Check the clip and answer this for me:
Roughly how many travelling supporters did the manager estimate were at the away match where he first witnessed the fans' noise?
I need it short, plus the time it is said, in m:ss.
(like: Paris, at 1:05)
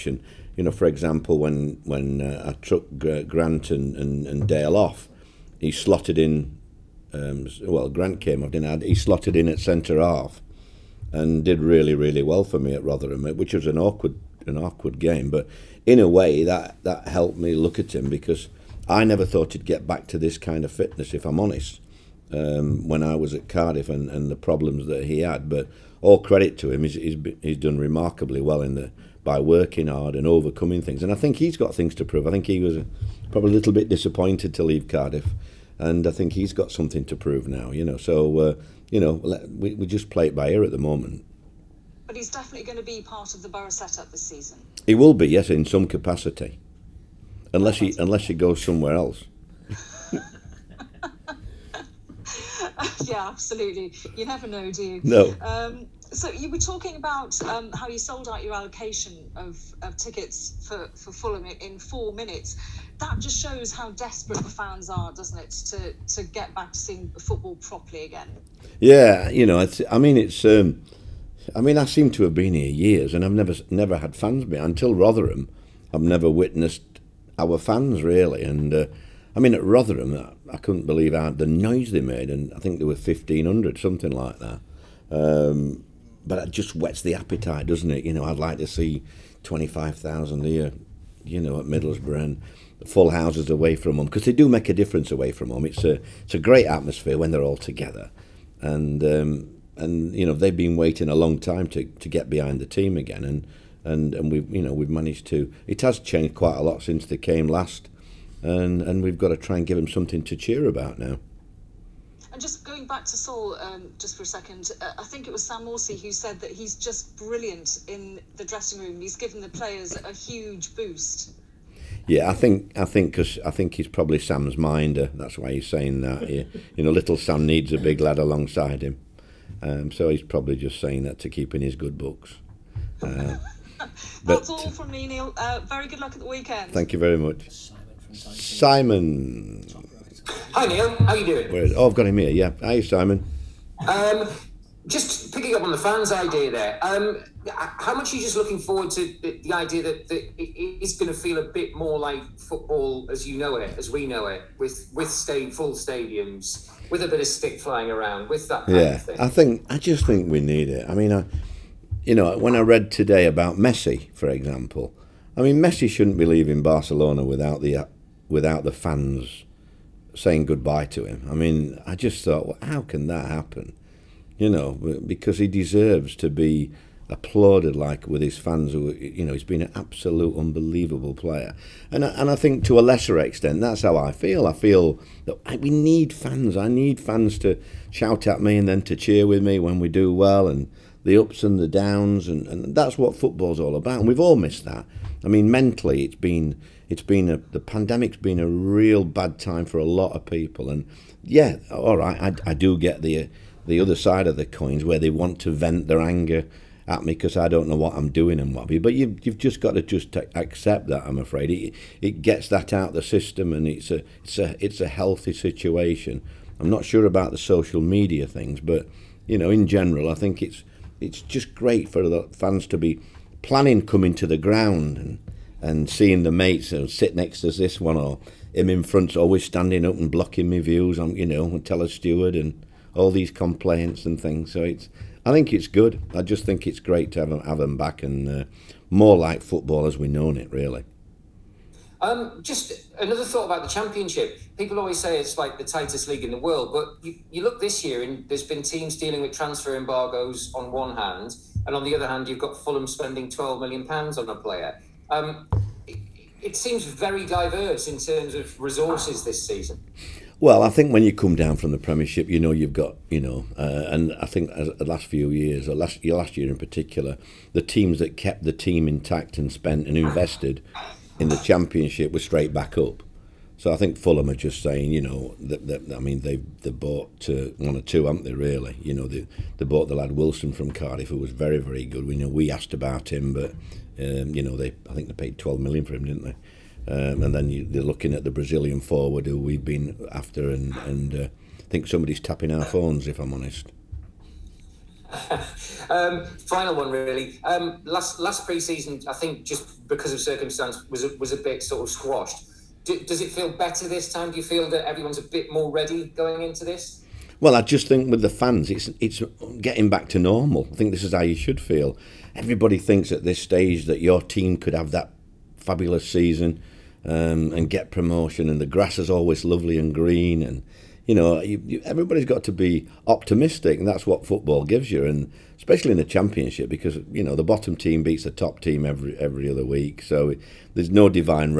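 1500, at 1:22.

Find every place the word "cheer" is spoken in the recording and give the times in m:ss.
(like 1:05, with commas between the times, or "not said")
1:50, 3:08.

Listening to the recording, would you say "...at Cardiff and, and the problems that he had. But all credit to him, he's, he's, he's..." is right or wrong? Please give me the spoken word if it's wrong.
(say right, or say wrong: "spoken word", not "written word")
right.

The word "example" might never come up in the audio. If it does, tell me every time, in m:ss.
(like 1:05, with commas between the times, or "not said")
0:00, 2:44.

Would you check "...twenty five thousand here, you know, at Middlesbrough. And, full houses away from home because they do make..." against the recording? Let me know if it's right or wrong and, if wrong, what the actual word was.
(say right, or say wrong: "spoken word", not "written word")
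right.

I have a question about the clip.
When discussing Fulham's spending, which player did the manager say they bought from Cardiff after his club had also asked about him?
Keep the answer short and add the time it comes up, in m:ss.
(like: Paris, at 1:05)
Wilson, at 4:40.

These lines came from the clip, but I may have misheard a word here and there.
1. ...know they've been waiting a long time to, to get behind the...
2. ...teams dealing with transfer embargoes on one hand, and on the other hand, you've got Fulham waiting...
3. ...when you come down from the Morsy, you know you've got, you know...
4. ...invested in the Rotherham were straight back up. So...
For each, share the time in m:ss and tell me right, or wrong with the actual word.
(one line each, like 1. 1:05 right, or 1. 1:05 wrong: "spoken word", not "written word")
1. 1:40 right
2. 4:08 wrong: "spending", not "waiting"
3. 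4:20 wrong: "Premiership", not "Morsy"
4. 4:29 wrong: "Championship", not "Rotherham".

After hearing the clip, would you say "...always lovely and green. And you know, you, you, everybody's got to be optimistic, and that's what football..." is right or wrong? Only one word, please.
right.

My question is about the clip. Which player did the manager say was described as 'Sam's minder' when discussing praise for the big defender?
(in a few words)
Sam Morsy.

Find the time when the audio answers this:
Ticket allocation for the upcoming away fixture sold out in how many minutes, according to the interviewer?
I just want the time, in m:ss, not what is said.
1:01.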